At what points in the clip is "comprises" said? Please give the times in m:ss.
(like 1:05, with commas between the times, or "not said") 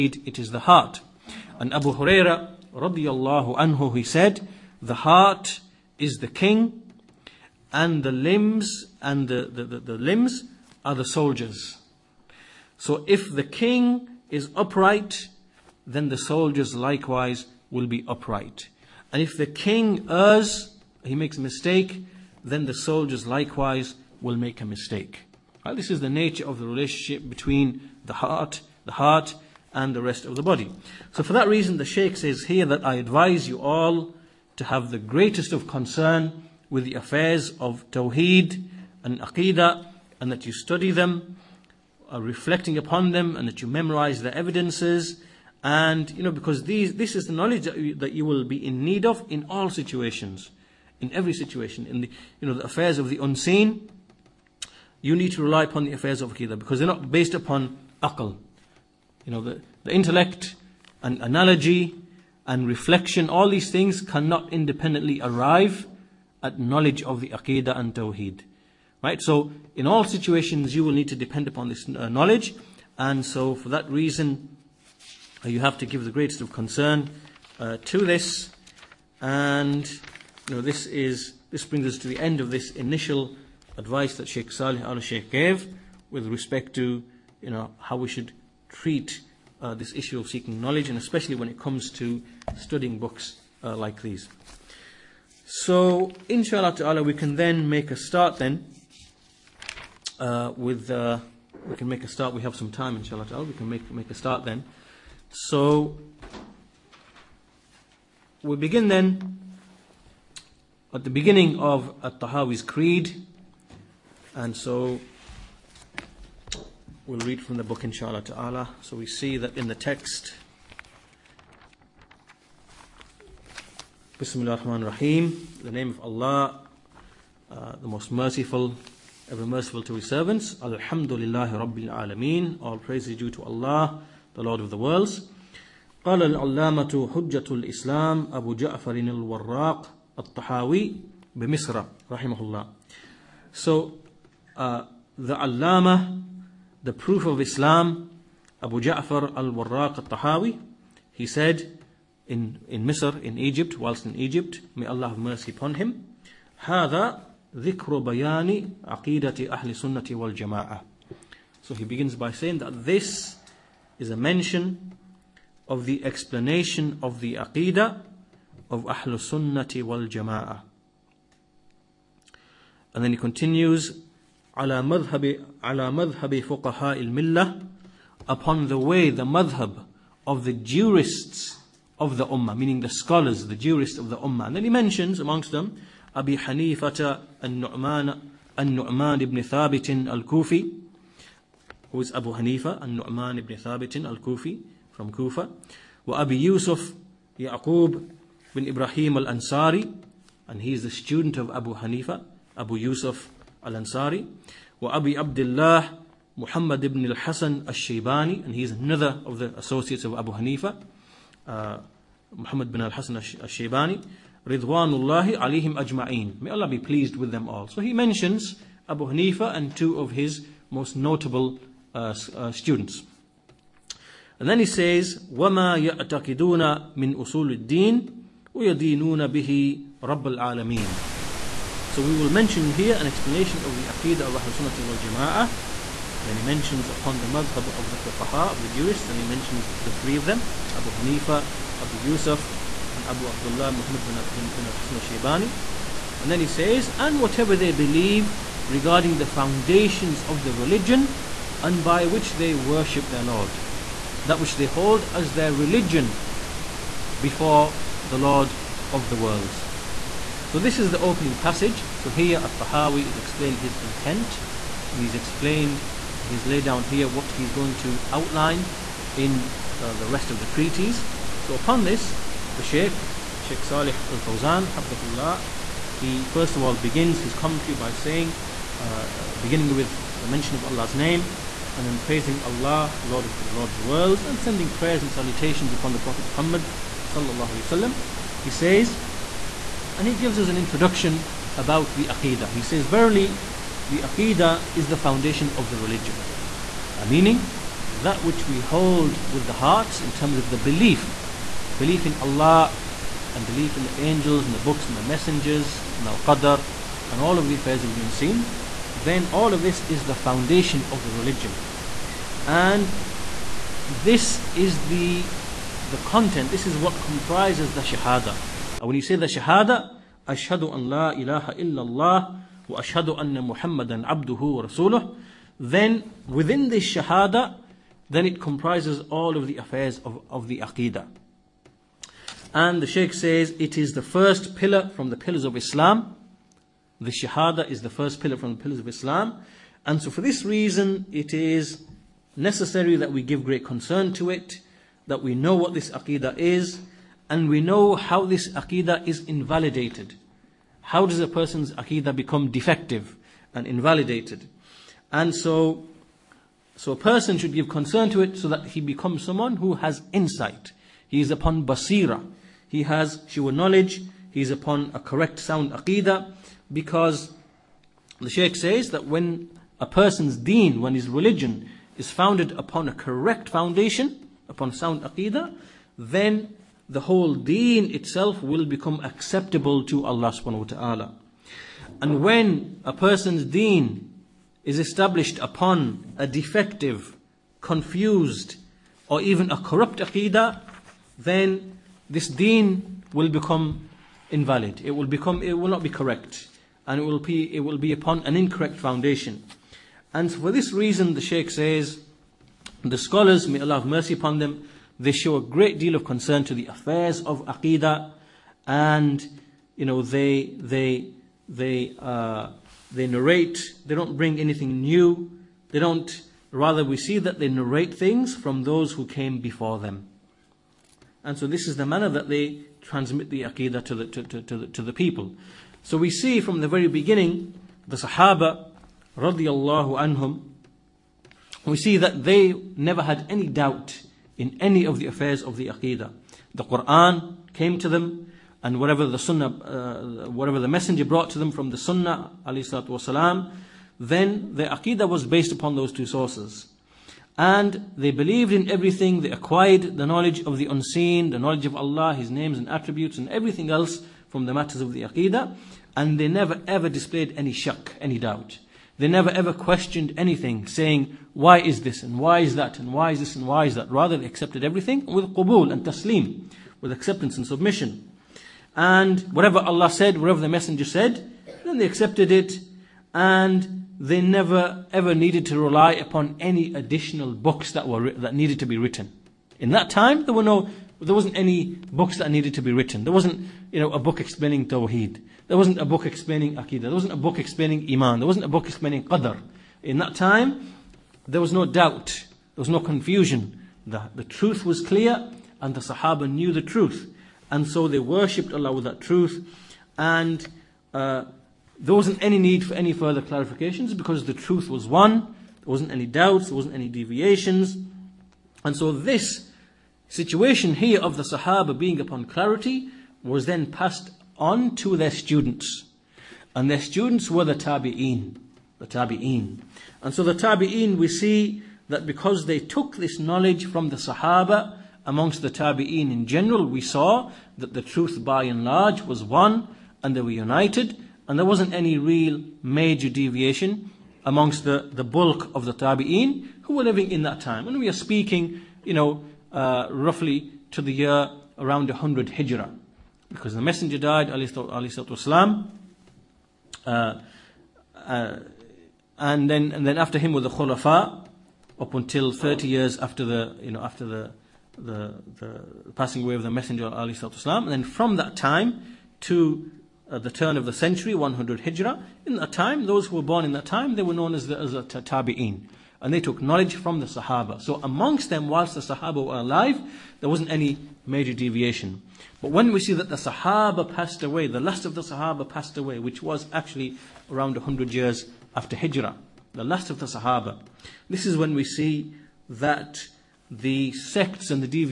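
5:17, 5:28.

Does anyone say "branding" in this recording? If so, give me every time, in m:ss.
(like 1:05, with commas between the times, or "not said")
not said.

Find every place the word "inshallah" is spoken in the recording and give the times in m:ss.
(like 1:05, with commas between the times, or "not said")
1:36, 1:42, 1:57.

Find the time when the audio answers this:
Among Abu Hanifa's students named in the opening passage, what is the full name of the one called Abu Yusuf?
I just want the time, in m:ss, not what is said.
3:17.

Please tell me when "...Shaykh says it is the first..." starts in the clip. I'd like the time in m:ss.
5:32.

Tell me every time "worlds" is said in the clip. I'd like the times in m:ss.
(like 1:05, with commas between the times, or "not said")
2:14, 4:19, 4:43.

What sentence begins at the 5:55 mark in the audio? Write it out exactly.
And so, so a person should give concern to it so that he becomes someone who has insight.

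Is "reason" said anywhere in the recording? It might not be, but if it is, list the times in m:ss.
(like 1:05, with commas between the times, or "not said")
0:31, 1:13, 5:40, 6:40.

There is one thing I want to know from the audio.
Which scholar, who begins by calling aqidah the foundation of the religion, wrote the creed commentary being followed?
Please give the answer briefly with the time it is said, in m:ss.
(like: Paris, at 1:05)
Salih Al-Fawzan, at 4:33.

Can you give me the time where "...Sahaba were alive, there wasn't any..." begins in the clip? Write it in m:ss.
9:28.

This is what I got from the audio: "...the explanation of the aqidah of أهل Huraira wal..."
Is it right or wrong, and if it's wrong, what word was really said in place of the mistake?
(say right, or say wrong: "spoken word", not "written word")
wrong: "Sunnati", not "Huraira".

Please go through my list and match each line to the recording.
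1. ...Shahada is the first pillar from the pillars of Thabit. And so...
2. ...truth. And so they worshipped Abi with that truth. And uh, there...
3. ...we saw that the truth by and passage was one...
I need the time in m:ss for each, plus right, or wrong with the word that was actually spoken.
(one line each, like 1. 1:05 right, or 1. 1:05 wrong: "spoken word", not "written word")
1. 5:37 wrong: "Islam", not "Thabit"
2. 8:16 wrong: "Allah", not "Abi"
3. 8:46 wrong: "large", not "passage".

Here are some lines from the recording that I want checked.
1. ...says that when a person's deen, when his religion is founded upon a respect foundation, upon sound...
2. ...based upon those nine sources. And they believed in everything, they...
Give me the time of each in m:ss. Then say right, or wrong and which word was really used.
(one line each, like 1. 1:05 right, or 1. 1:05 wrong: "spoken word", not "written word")
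1. 6:08 wrong: "correct", not "respect"
2. 7:25 wrong: "two", not "nine".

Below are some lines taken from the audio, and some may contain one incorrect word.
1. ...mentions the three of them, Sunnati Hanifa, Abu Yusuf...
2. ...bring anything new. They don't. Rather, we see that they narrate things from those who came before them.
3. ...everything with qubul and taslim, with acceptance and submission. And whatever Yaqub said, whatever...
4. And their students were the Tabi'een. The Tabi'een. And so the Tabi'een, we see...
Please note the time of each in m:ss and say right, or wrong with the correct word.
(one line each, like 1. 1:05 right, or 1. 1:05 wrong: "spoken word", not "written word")
1. 3:59 wrong: "Abu", not "Sunnati"
2. 6:54 right
3. 7:44 wrong: "Allah", not "Yaqub"
4. 8:36 right.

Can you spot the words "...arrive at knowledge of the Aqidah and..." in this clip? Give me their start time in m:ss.
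1:05.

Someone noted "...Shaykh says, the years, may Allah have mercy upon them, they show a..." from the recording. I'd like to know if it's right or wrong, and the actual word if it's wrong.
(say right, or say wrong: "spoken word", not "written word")
wrong: "scholars", not "years".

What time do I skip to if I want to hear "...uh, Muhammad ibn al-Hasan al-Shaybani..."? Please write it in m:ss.
3:31.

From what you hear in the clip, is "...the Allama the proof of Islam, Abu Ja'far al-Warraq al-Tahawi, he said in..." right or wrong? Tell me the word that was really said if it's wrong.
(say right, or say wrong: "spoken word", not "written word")
right.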